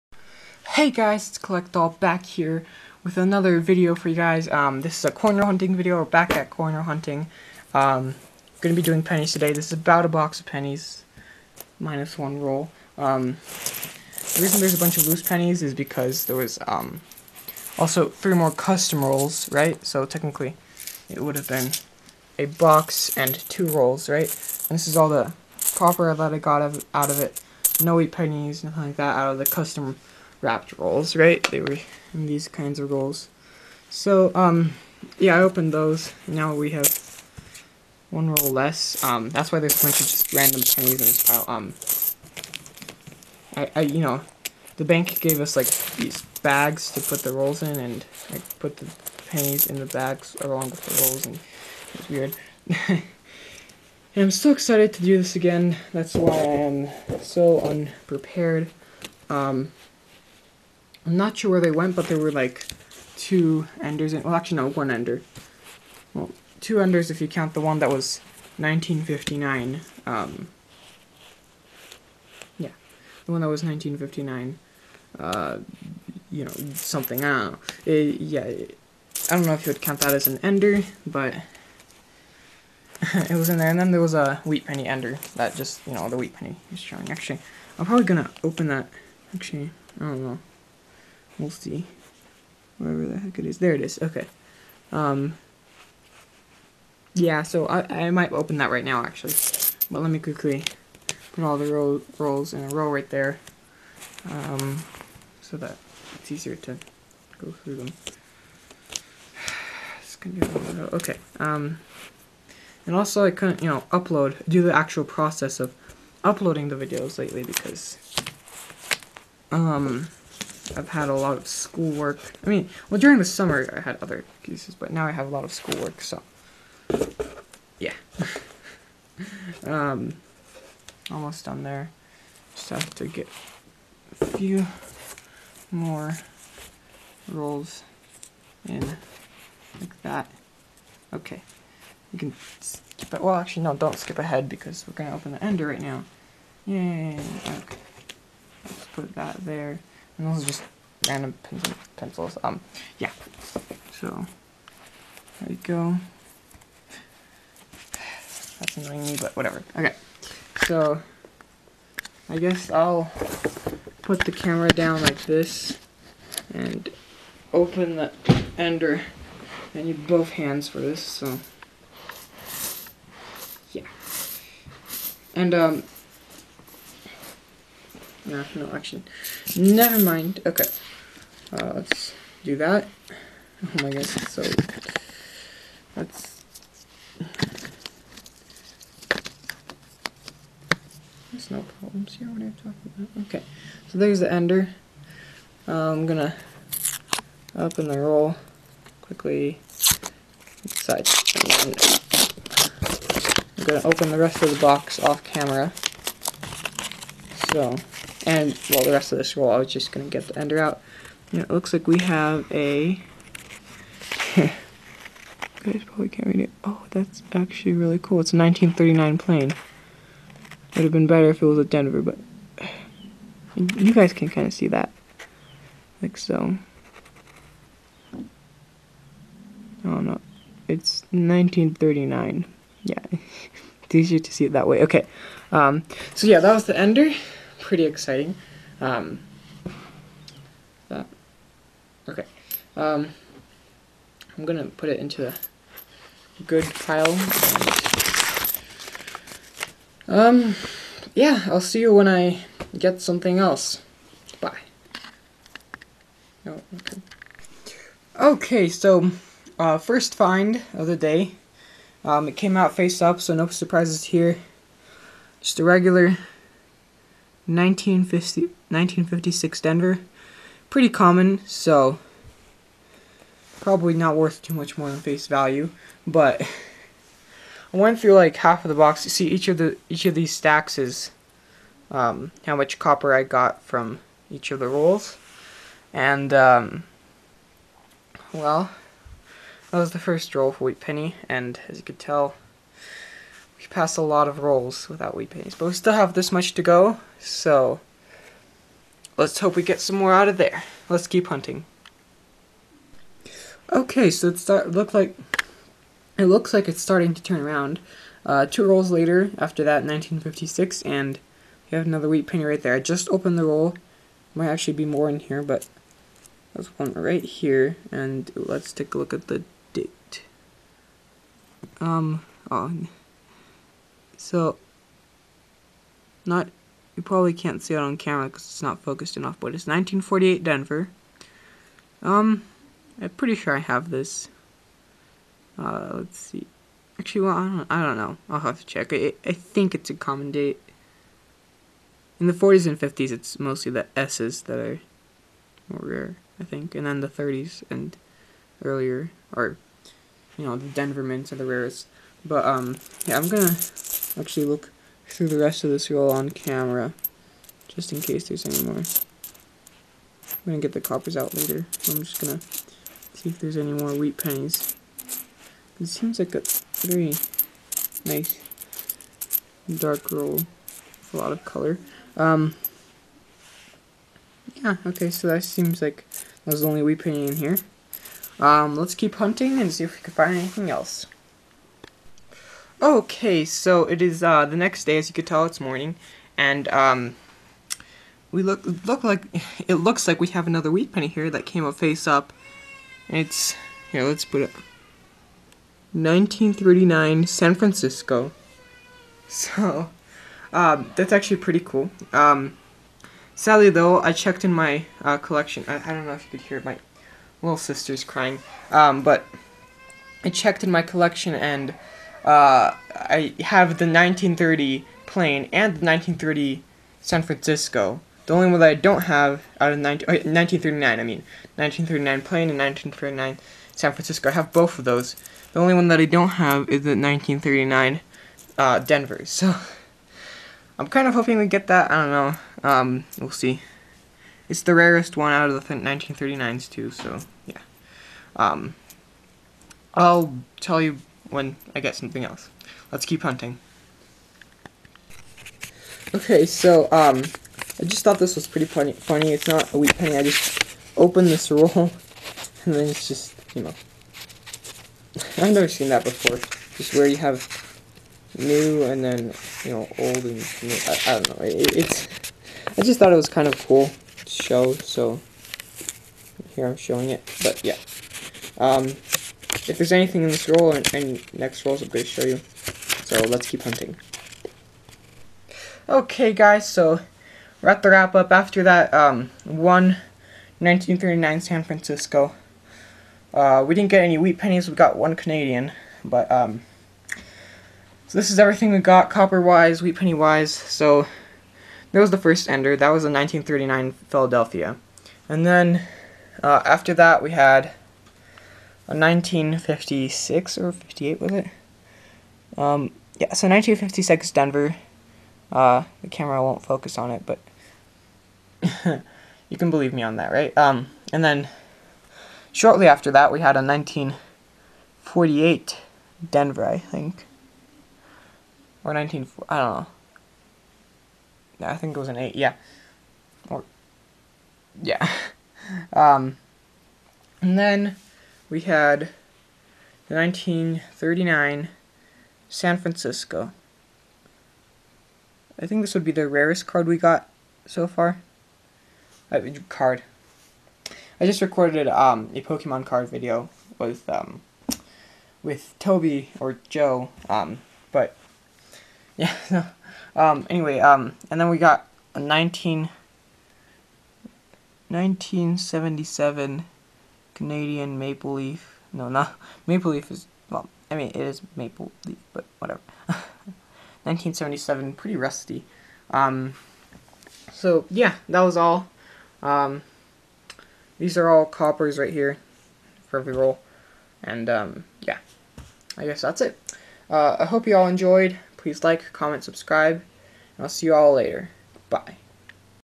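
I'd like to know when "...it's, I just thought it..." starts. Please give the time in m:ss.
7:41.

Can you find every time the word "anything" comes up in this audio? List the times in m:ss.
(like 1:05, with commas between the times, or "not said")
6:20, 7:49.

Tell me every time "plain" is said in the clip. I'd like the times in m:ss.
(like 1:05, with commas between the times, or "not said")
3:39, 6:55, 7:02.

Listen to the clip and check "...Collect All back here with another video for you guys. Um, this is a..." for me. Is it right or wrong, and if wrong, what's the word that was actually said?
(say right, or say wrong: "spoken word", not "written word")
right.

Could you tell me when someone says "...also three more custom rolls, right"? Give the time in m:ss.
0:17.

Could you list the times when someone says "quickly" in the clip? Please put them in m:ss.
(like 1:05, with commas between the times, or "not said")
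1:40, 3:19.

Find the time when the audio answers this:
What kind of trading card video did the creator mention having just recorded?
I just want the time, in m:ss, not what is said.
9:02.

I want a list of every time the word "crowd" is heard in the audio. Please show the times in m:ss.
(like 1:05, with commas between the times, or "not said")
not said.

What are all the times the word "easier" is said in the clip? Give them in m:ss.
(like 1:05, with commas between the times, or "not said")
1:46, 3:53.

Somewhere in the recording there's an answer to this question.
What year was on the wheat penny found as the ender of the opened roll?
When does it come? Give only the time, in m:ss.
3:38.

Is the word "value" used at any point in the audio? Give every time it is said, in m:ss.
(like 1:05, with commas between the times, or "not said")
4:35.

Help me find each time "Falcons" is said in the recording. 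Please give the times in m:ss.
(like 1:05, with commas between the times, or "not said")
not said.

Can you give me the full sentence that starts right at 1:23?
And then there was a wheat penny ender that just, you know, the wheat penny is showing.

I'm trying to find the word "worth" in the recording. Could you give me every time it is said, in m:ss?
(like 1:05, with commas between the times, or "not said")
4:34.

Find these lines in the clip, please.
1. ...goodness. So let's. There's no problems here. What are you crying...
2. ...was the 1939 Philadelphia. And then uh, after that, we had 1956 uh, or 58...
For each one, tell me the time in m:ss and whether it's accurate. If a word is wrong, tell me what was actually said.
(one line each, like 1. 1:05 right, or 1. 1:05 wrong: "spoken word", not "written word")
1. 3:03 wrong: "talking", not "crying"
2. 8:12 right.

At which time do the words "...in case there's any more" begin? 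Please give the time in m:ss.
5:57.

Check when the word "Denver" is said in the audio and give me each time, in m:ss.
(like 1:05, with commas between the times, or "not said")
3:41, 4:29, 5:30, 5:50, 7:08, 8:24, 8:36.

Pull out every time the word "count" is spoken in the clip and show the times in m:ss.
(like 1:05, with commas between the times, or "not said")
1:07, 1:19.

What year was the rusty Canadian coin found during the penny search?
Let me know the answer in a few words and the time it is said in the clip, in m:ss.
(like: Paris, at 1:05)
1977, at 9:14.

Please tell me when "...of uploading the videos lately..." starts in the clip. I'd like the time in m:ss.
1:55.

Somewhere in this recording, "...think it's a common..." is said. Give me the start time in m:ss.
5:39.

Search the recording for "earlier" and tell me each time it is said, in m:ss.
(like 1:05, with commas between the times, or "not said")
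5:48.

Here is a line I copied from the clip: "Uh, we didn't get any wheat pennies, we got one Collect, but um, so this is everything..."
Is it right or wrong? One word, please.
wrong.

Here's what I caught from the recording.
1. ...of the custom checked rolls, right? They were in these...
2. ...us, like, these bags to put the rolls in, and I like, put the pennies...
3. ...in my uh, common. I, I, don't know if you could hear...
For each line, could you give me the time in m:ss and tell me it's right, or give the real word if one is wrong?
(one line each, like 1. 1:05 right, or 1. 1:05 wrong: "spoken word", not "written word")
1. 0:29 wrong: "wrapped", not "checked"
2. 0:45 right
3. 6:44 wrong: "collection", not "common".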